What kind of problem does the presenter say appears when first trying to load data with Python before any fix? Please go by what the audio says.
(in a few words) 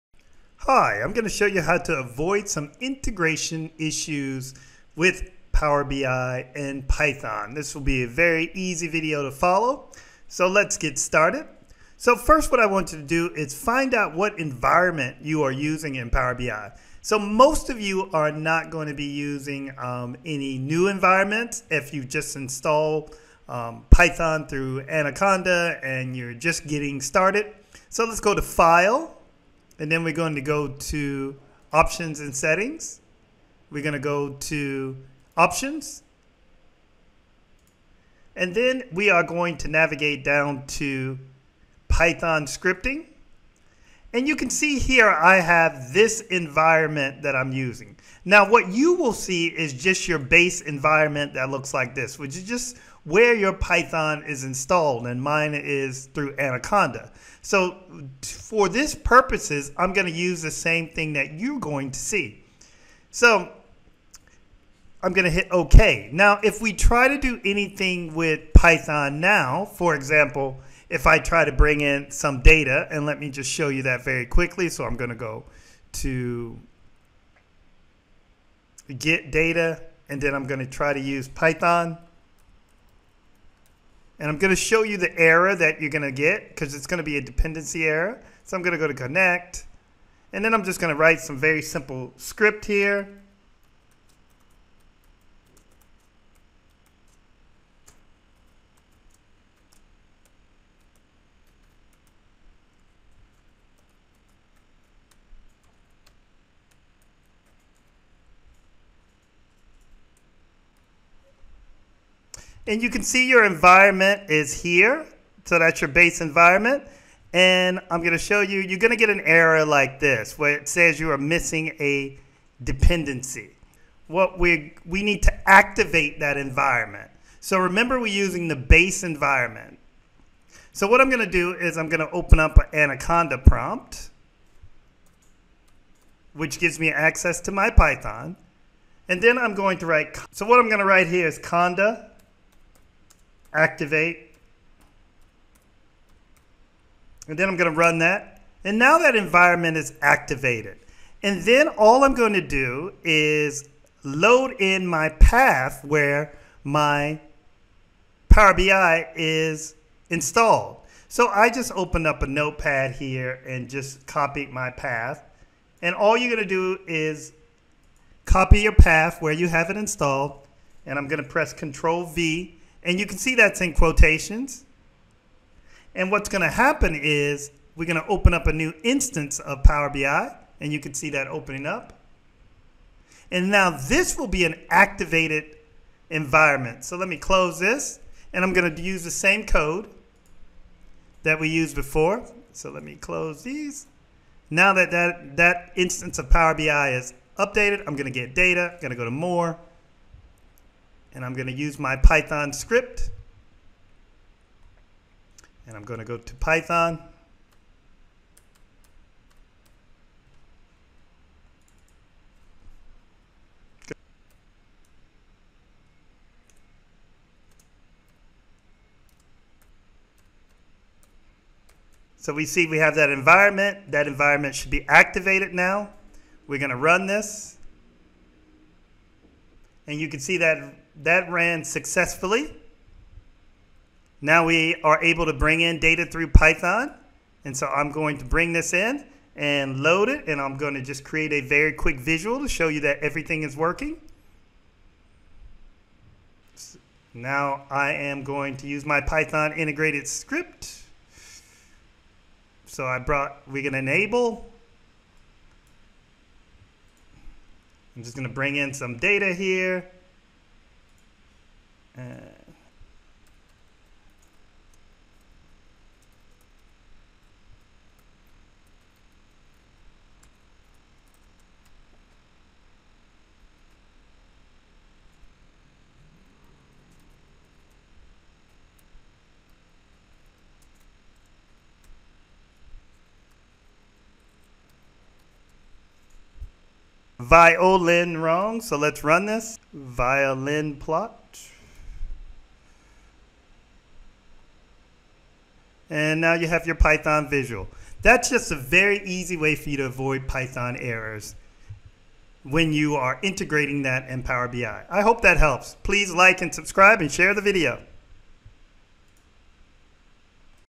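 Dependency error.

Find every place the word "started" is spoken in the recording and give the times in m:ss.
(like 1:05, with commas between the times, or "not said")
0:10, 0:27.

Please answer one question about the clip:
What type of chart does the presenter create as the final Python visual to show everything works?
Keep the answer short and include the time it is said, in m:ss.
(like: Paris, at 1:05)
Violin plot, at 4:49.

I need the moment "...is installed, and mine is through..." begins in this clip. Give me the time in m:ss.
0:54.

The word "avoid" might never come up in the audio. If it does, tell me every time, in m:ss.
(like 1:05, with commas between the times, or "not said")
0:01, 4:59.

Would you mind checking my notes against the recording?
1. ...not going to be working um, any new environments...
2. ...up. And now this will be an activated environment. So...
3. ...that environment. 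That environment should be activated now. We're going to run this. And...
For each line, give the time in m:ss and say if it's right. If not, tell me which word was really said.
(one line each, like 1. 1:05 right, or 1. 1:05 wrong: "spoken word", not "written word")
1. 0:18 wrong: "using", not "working"
2. 3:01 right
3. 3:42 right.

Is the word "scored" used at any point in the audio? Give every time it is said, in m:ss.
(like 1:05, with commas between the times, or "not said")
not said.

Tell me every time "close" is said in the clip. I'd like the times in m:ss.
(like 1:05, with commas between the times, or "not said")
3:07, 3:12.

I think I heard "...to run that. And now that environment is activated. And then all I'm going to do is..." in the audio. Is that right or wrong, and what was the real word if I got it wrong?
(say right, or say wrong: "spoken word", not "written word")
right.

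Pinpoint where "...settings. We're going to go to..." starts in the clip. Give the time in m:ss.
0:32.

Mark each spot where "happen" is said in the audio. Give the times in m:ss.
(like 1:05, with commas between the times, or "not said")
2:56.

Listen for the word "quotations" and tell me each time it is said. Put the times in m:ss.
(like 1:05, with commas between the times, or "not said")
2:53.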